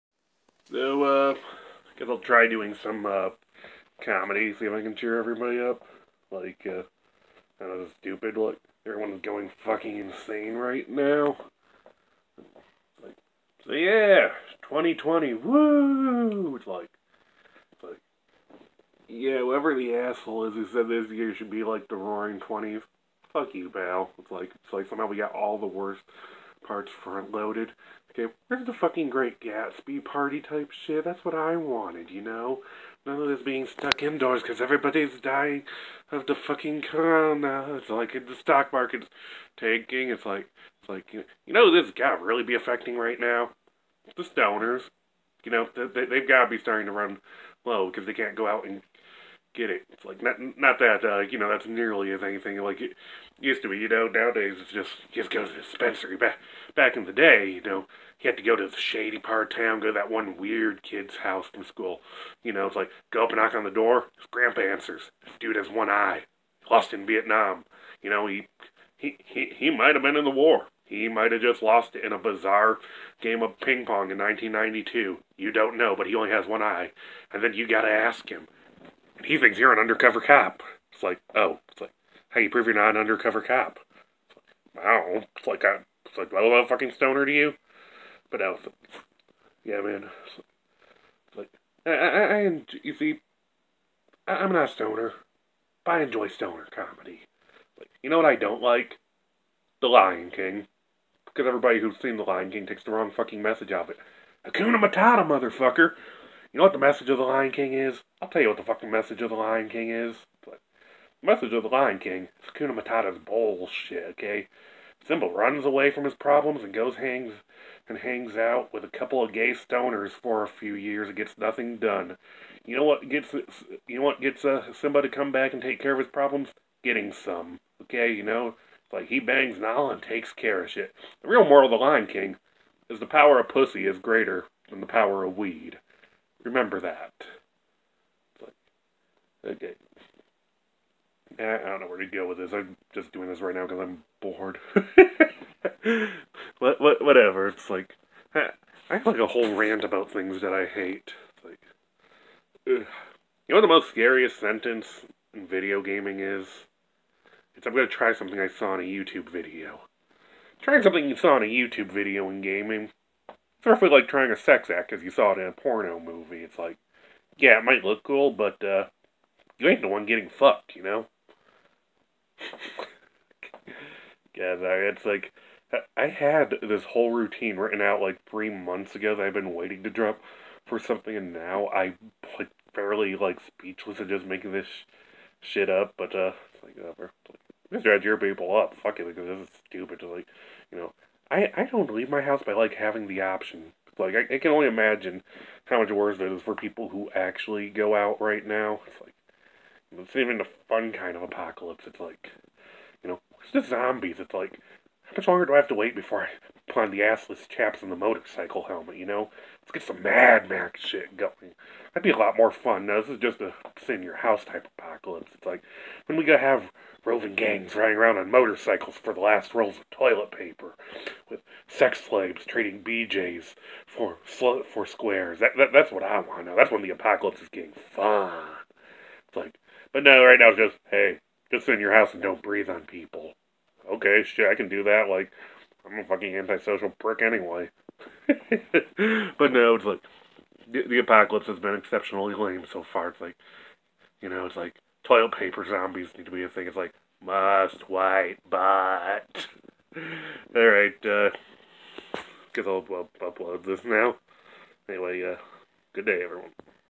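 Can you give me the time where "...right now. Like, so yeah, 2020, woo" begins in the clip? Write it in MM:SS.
00:10.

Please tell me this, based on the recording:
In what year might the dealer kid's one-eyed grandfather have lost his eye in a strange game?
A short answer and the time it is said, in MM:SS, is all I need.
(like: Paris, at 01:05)
1992, at 01:14.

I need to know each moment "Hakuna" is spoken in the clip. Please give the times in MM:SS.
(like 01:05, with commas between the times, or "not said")
01:44, 01:52.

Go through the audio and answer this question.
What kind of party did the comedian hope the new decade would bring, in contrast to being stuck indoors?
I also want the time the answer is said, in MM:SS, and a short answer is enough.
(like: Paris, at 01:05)
Great Gatsby party, at 00:29.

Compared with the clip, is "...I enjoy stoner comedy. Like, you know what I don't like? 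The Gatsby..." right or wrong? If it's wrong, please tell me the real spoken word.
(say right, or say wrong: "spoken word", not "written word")
wrong: "Lion", not "Gatsby".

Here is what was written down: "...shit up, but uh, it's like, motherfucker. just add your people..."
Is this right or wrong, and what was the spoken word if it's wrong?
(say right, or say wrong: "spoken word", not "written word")
wrong: "whatever", not "motherfucker".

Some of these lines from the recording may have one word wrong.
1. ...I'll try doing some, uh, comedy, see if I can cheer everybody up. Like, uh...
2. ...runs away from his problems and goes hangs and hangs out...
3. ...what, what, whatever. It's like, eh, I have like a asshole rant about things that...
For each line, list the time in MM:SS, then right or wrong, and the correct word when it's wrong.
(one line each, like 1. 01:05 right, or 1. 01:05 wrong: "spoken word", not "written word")
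1. 00:02 right
2. 01:55 right
3. 02:26 wrong: "whole", not "asshole".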